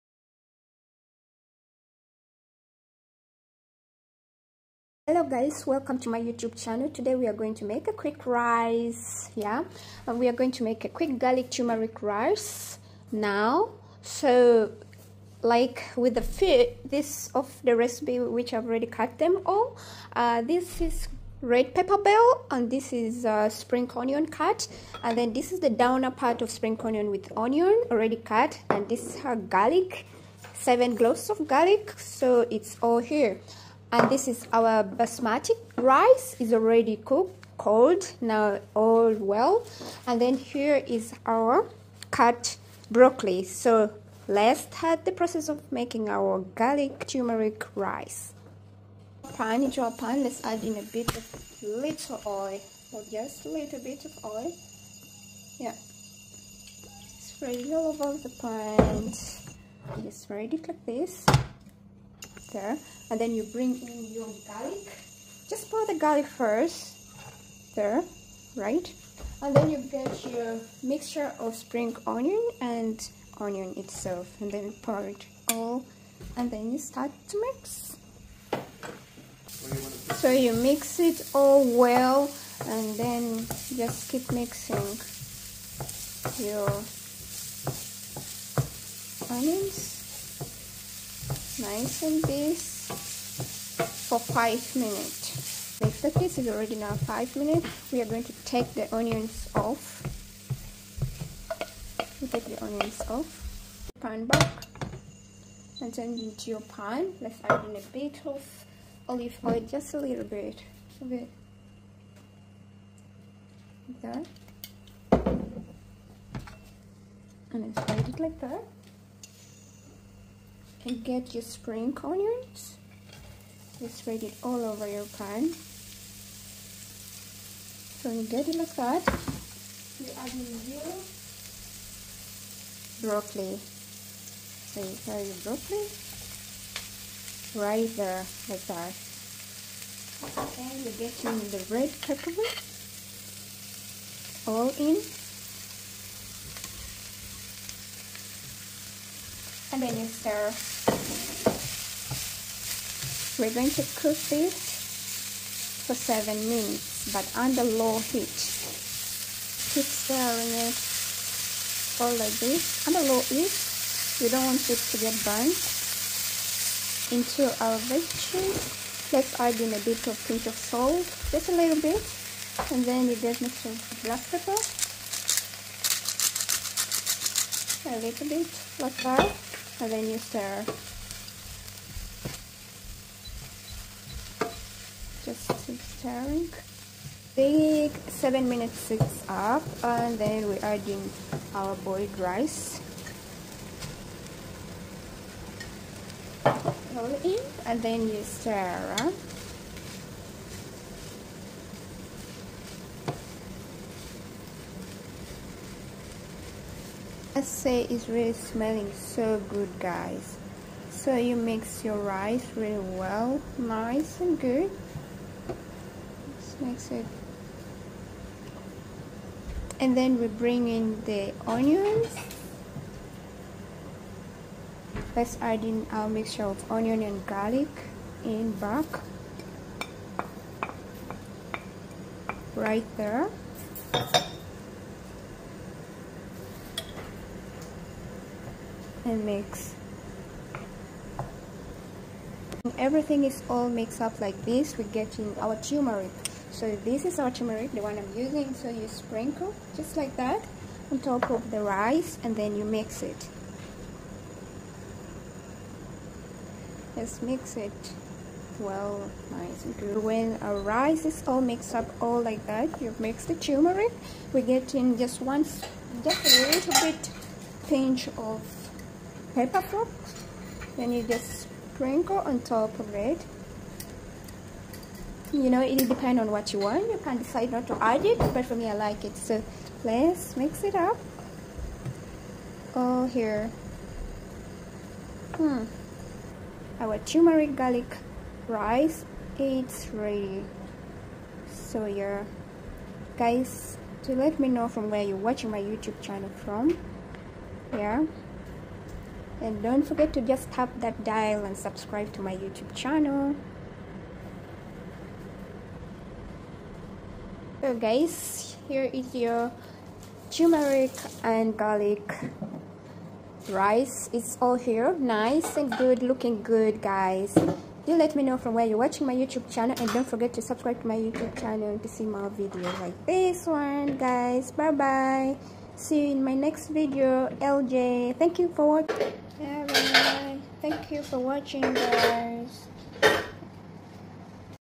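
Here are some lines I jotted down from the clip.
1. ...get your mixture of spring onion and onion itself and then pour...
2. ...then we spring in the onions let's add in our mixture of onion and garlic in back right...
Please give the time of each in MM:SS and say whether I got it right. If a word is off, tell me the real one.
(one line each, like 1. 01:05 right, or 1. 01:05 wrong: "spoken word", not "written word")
1. 01:09 right
2. 03:39 wrong: "bring", not "spring".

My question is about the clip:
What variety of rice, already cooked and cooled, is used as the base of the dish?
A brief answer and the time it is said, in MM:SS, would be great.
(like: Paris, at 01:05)
basmati, at 00:34.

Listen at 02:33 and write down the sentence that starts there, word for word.
We're going to cook this for 7 minutes but under low heat.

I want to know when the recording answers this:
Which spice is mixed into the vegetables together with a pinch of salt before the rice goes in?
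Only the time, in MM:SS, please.
02:54.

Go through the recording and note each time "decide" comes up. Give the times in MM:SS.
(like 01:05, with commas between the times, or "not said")
04:37.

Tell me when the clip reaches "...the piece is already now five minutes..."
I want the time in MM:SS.
01:36.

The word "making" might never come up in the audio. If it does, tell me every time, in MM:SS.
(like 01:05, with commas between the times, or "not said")
00:45.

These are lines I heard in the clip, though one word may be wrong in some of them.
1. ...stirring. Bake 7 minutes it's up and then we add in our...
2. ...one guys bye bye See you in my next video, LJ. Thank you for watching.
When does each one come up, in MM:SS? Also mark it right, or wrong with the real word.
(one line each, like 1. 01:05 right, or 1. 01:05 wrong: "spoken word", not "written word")
1. 03:05 right
2. 05:23 right.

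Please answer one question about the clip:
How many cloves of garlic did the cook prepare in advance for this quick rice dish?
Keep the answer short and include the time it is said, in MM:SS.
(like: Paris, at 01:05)
7, at 00:30.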